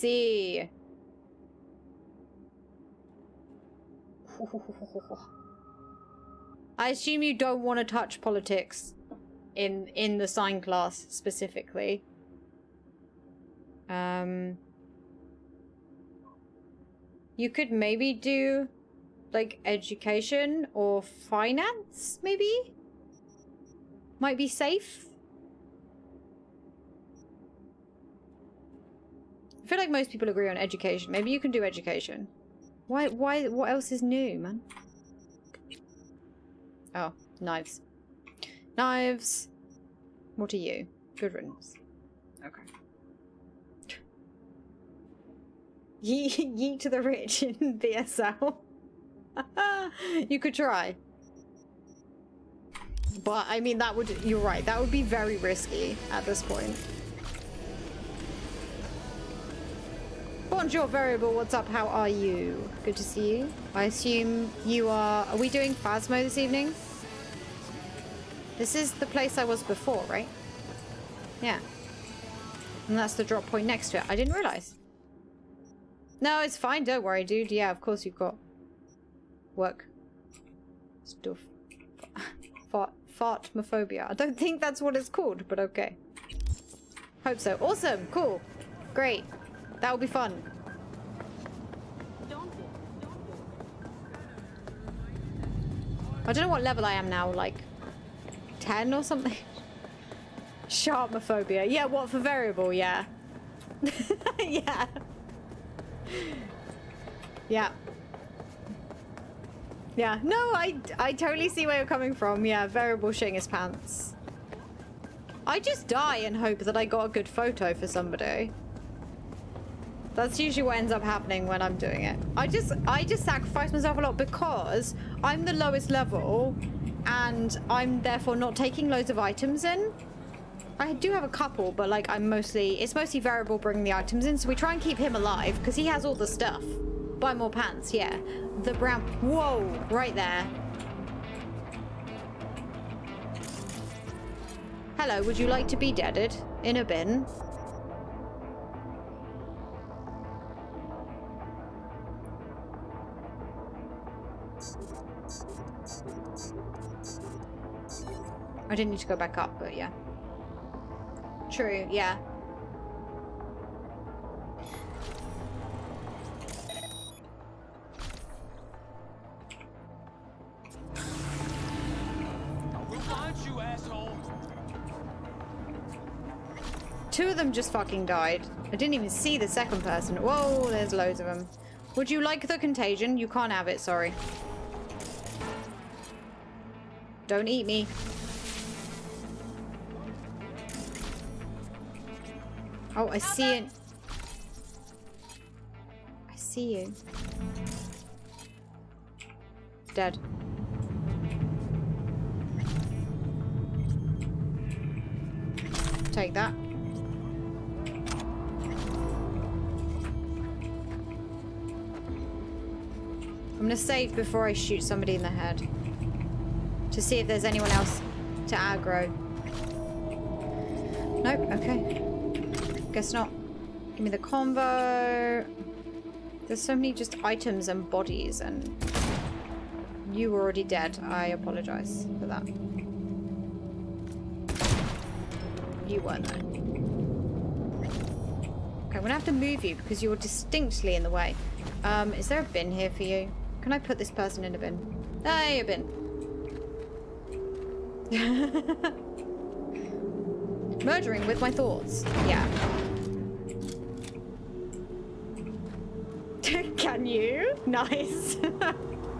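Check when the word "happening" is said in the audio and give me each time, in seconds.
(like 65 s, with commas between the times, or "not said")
121 s.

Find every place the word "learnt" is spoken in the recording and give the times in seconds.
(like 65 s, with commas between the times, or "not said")
not said.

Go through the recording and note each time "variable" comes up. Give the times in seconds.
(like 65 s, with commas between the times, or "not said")
60 s, 102 s, 112 s, 133 s.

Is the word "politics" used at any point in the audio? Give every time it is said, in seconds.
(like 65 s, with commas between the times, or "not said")
8 s.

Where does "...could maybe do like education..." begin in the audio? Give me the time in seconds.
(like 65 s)
17 s.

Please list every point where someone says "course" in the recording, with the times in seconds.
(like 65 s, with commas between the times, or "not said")
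77 s.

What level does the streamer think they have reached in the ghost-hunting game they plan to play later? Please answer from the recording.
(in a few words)
10.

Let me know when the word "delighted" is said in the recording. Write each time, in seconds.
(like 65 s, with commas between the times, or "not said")
not said.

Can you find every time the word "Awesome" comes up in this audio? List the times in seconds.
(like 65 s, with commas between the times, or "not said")
87 s.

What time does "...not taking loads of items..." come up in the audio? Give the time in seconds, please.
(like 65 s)
128 s.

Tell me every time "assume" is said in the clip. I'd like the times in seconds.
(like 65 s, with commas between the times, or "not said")
6 s, 63 s.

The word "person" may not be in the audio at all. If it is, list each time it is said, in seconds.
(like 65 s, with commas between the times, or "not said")
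179 s, 244 s.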